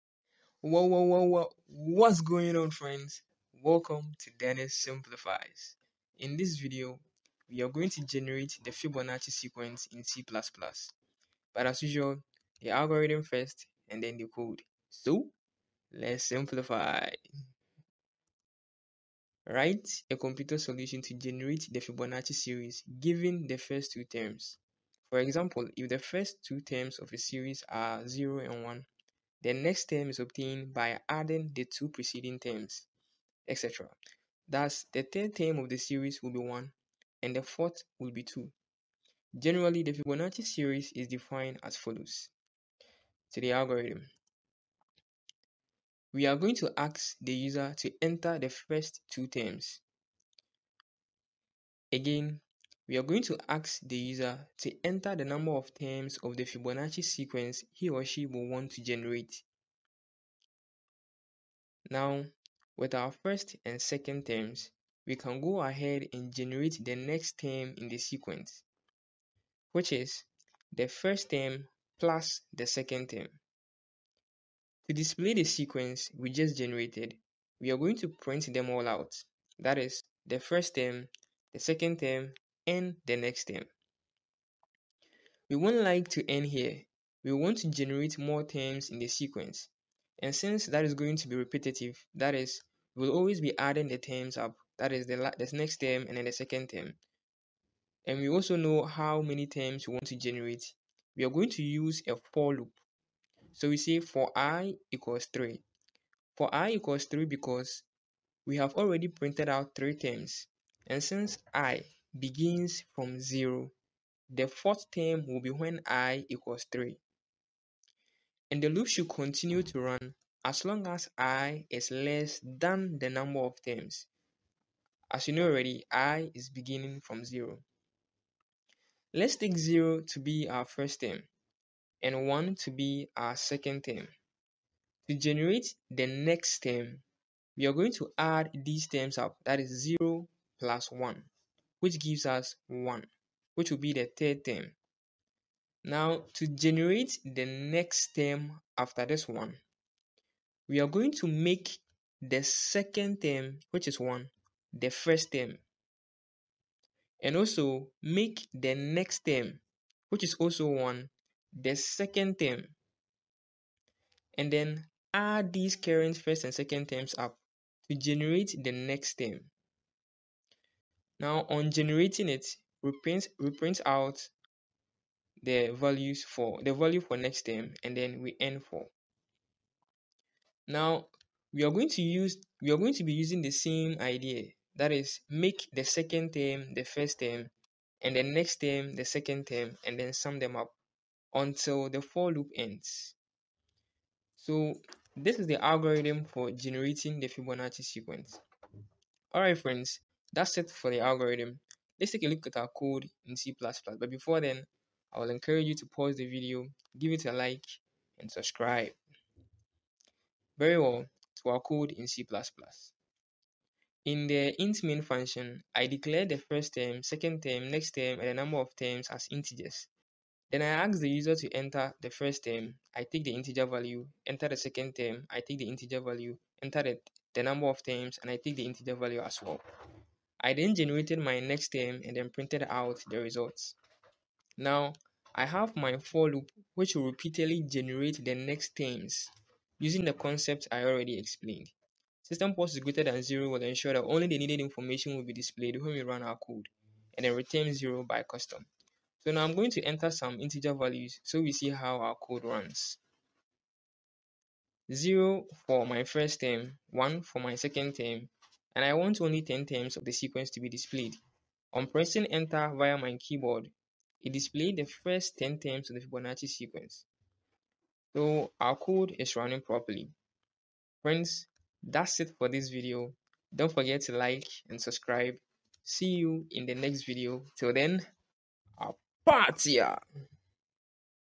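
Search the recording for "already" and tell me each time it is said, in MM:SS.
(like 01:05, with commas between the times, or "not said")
01:48, 02:05, 04:00.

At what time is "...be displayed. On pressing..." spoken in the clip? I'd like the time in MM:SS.
04:20.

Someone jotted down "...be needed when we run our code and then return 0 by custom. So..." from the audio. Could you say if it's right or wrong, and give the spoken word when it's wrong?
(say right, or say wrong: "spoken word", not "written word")
wrong: "displayed", not "needed".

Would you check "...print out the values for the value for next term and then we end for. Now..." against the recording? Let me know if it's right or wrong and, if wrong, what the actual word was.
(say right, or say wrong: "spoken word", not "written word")
right.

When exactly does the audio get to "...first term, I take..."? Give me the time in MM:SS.
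03:42.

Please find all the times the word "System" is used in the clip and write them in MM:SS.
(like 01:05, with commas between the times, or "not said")
04:02.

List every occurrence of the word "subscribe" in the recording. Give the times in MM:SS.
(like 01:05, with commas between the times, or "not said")
03:28, 04:34.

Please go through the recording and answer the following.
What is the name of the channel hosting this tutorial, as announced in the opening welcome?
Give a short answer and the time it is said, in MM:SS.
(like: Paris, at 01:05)
Dennis Simplifies, at 00:04.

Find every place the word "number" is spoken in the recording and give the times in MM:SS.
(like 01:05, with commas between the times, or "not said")
00:55, 02:03, 03:38, 03:47.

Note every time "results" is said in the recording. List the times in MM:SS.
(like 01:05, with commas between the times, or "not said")
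03:53.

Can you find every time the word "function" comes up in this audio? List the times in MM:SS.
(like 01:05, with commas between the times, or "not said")
03:35.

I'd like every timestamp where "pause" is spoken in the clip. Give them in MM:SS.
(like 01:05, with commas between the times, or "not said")
03:25, 04:02.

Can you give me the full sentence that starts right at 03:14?
So this is the algorithm for generating the Fibonacci sequence.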